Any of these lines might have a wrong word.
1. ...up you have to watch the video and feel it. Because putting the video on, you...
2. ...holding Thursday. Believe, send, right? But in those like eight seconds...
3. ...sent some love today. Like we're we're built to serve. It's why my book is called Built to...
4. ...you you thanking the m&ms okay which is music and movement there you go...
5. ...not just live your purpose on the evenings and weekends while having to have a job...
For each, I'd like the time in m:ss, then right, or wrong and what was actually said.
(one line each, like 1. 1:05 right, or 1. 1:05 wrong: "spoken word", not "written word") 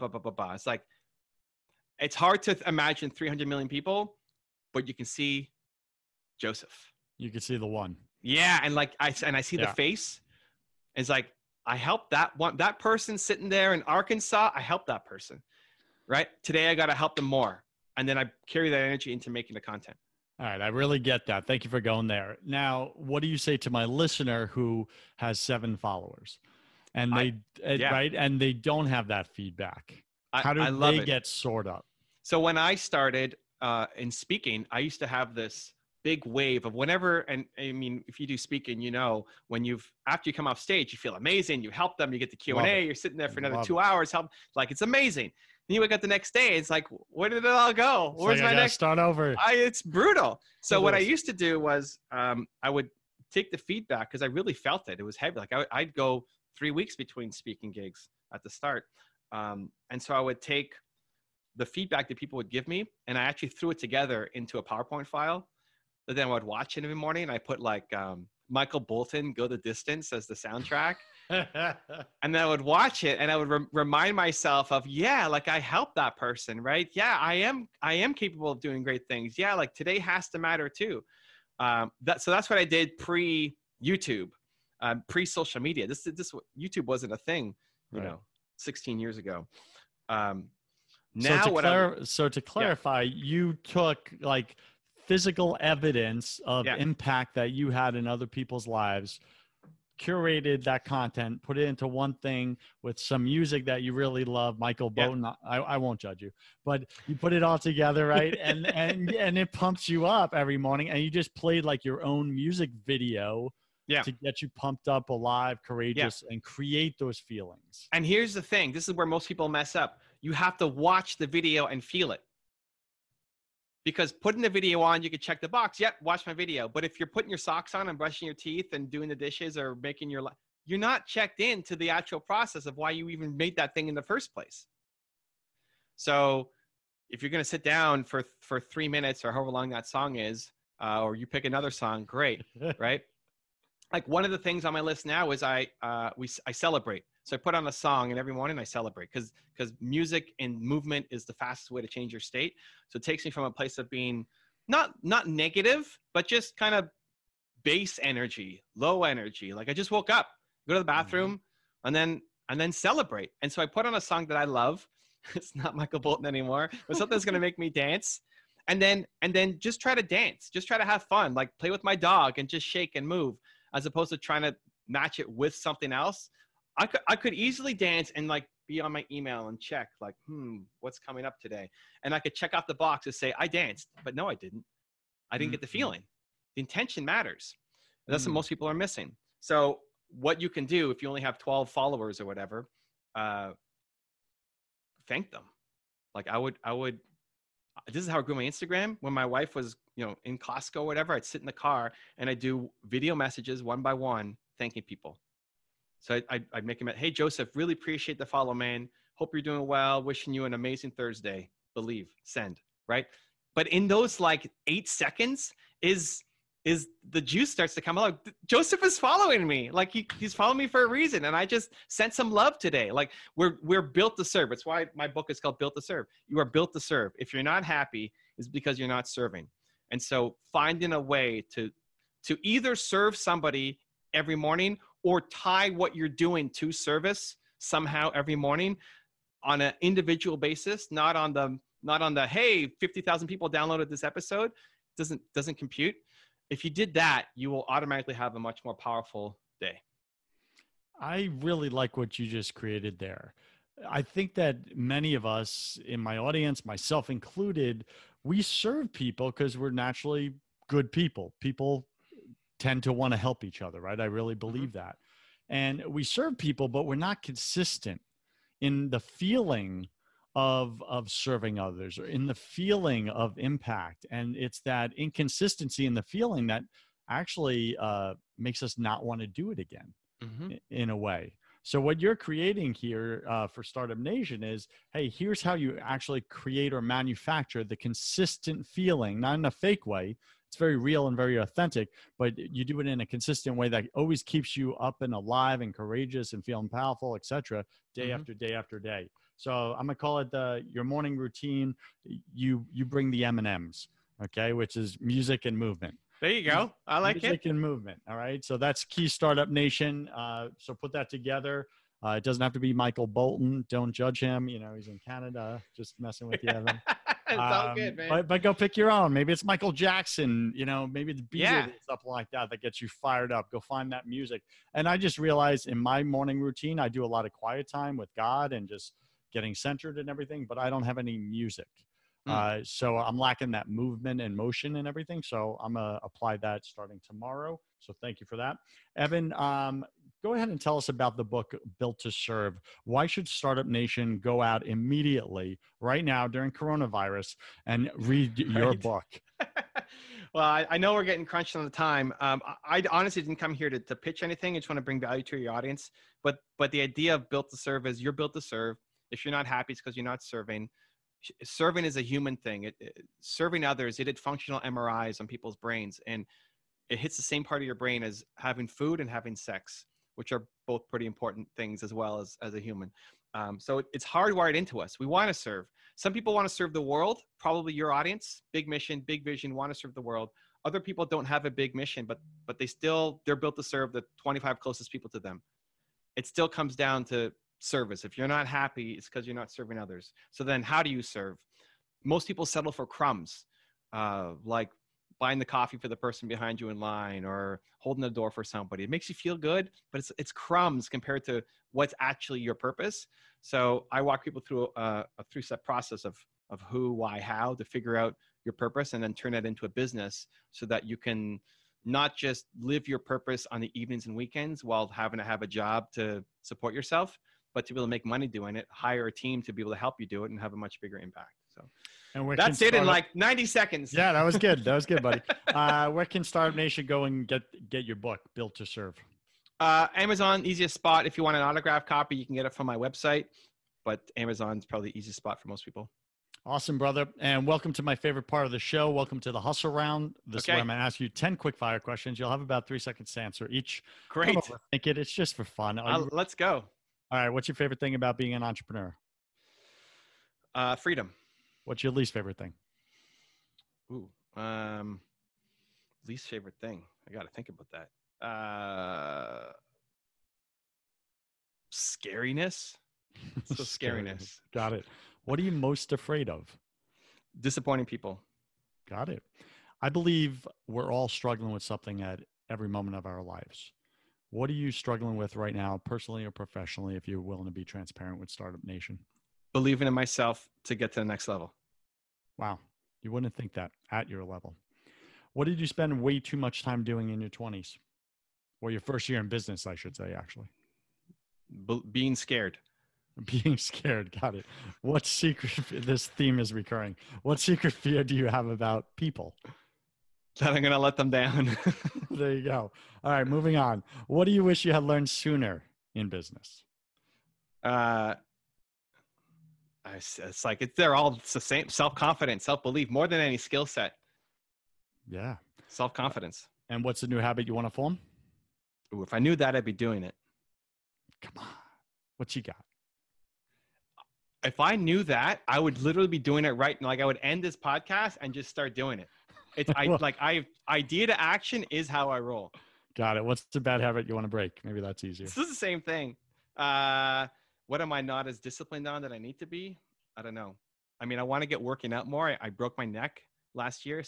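1. 1:59 right
2. 3:30 wrong: "amazing", not "holding"
3. 3:41 right
4. 5:02 wrong: "bring", not "thanking"
5. 6:51 right.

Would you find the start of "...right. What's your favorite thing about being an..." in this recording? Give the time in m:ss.
7:27.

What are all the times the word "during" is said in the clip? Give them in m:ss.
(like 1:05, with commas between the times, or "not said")
5:46.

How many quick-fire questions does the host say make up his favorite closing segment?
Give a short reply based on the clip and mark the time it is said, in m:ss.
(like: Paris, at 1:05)
10, at 7:21.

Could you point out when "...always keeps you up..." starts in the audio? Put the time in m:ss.
4:53.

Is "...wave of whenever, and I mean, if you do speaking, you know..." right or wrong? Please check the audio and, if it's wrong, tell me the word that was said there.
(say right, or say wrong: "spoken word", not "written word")
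right.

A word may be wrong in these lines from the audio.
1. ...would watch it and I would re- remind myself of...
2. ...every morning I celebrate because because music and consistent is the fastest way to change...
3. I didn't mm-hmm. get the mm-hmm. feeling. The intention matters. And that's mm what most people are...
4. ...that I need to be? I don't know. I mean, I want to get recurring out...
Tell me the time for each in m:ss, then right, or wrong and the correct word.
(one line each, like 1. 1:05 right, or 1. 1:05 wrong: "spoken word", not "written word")
1. 1:12 right
2. 2:28 wrong: "movement", not "consistent"
3. 3:05 right
4. 8:59 wrong: "working", not "recurring".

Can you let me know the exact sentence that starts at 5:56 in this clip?
But but the idea of Built to Serve is you're built to serve.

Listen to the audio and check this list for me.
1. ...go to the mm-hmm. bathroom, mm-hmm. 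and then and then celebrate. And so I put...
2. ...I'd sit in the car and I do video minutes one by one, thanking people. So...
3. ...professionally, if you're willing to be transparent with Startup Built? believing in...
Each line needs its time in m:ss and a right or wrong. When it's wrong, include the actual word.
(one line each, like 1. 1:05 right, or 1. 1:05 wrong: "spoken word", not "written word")
1. 2:40 right
2. 3:21 wrong: "messages", not "minutes"
3. 7:56 wrong: "Nation", not "Built".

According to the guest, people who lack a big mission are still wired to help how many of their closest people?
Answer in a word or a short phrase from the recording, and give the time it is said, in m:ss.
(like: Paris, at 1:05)
25, at 6:24.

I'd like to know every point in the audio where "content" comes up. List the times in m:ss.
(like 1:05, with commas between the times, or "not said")
0:19, 1:40.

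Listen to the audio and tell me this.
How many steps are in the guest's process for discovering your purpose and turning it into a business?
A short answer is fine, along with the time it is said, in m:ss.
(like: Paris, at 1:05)
3, at 6:45.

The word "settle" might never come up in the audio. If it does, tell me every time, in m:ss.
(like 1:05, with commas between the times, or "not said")
6:32.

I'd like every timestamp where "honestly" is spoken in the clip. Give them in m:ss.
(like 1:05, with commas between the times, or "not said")
5:52.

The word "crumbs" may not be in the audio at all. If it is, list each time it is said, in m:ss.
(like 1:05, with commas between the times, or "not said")
6:32, 6:40.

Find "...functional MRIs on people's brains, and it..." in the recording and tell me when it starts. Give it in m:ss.
6:04.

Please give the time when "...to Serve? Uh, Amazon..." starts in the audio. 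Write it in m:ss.
7:08.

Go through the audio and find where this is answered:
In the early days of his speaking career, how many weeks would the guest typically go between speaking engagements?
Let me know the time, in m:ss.
0:56.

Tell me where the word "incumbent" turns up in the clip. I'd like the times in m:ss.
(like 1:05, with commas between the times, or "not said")
not said.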